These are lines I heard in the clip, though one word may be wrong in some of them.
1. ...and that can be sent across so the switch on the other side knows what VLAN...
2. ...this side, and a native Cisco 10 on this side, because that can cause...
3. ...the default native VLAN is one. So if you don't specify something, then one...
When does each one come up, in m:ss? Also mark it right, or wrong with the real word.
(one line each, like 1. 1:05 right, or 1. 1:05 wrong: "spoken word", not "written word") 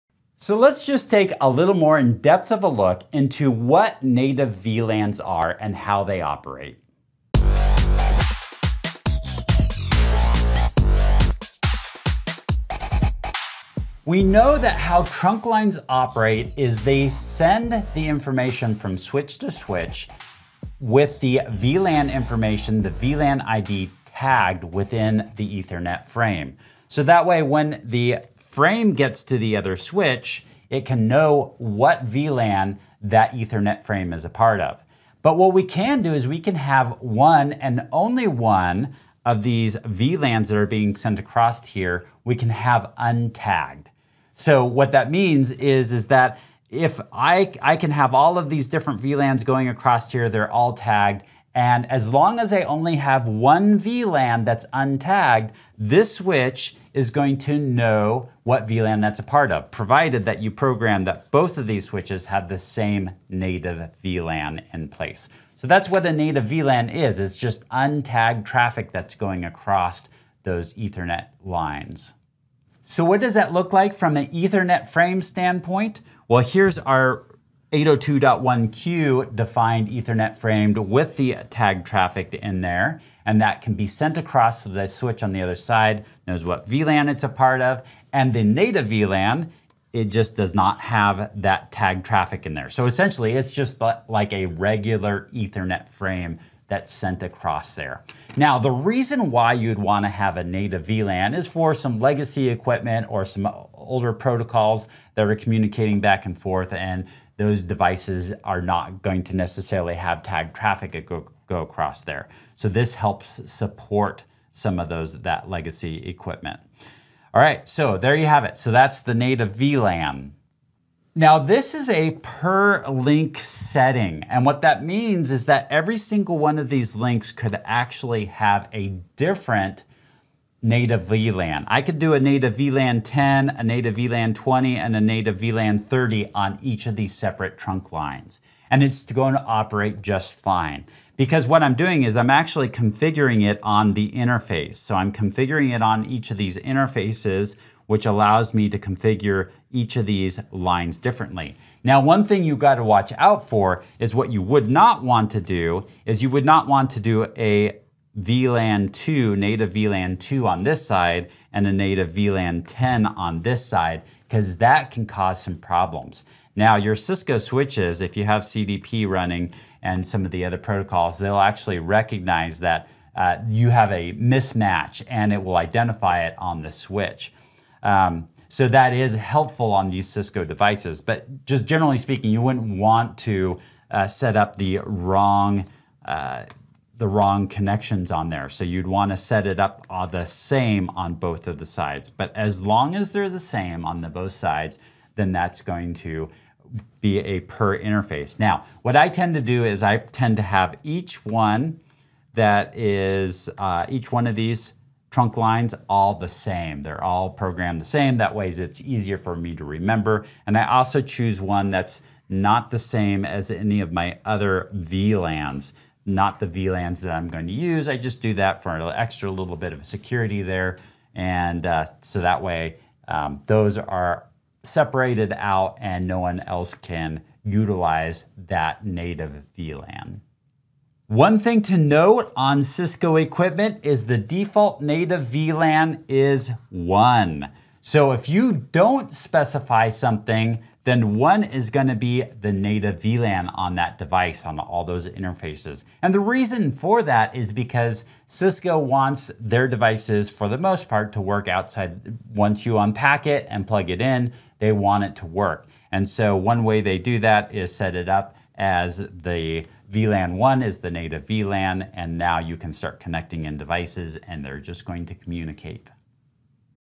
1. 1:23 right
2. 2:40 wrong: "VLAN", not "Cisco"
3. 3:54 right.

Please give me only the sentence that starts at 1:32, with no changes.
So essentially, it's just like a regular Ethernet frame that's sent across there.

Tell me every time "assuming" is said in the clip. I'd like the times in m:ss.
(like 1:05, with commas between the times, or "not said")
not said.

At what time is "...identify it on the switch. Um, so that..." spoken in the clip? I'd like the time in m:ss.
2:55.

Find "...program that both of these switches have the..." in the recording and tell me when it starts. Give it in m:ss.
1:00.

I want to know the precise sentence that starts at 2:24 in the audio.
So I'm configuring it on each of these interfaces, which allows me to configure each of these lines differently.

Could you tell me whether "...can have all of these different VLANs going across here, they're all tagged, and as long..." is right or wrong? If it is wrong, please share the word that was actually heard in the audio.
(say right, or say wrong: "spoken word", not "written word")
right.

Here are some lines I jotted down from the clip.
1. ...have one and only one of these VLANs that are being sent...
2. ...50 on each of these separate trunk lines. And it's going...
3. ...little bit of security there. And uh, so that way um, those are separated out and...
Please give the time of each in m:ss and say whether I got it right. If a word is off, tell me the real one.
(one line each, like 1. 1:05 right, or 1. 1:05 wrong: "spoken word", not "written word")
1. 0:36 right
2. 2:15 wrong: "30", not "50"
3. 3:39 right.